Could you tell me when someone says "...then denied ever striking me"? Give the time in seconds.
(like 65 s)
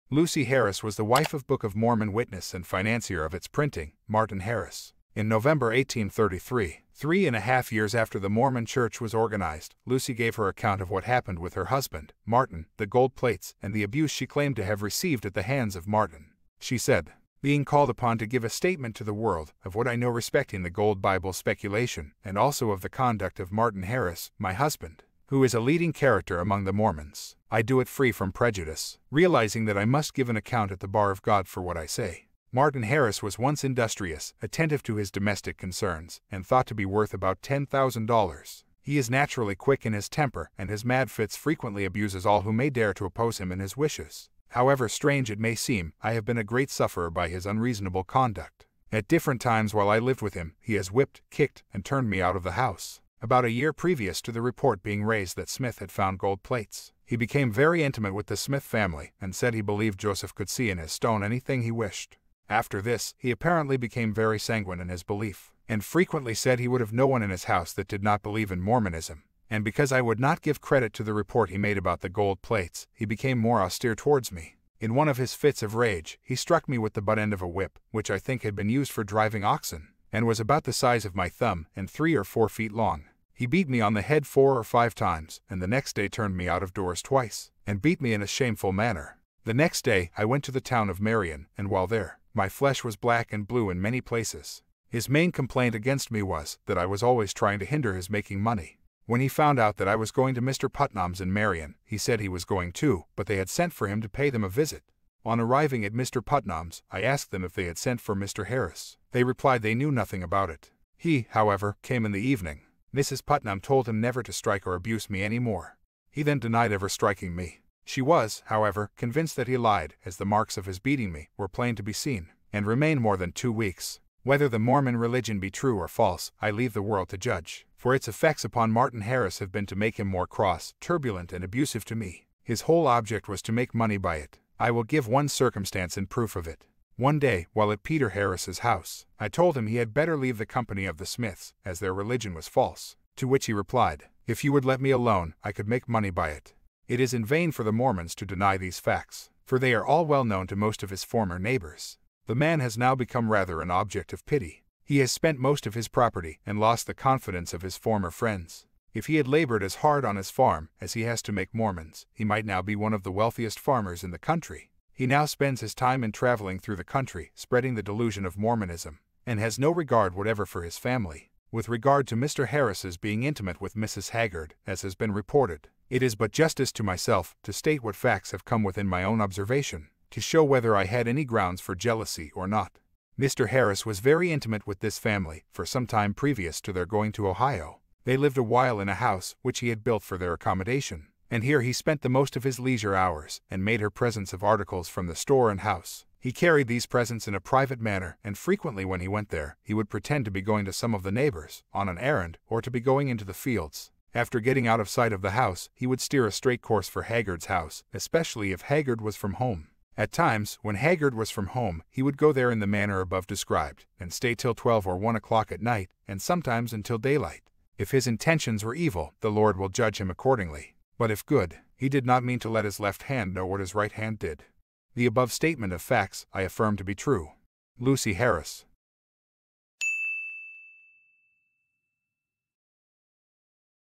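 116 s.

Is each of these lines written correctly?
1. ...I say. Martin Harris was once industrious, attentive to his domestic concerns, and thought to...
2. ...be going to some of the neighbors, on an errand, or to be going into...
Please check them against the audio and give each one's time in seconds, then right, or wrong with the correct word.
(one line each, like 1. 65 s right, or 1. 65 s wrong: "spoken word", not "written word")
1. 31 s right
2. 200 s right.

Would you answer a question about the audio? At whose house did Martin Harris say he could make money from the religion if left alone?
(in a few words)
Peter Harris.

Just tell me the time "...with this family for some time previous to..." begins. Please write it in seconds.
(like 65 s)
184 s.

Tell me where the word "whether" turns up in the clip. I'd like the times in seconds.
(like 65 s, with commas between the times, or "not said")
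124 s, 180 s.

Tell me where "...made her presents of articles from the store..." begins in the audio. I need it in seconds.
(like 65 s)
193 s.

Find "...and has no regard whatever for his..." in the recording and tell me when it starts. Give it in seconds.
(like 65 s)
169 s.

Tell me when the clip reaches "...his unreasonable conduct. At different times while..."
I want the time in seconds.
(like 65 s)
47 s.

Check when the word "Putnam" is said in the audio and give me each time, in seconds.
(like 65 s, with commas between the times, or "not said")
100 s, 106 s, 113 s.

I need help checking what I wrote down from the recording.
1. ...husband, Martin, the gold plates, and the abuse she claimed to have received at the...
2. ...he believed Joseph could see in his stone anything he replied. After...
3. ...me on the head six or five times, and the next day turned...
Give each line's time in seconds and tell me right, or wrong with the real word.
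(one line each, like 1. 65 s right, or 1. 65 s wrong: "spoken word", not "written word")
1. 11 s right
2. 59 s wrong: "wished", not "replied"
3. 83 s wrong: "four", not "six".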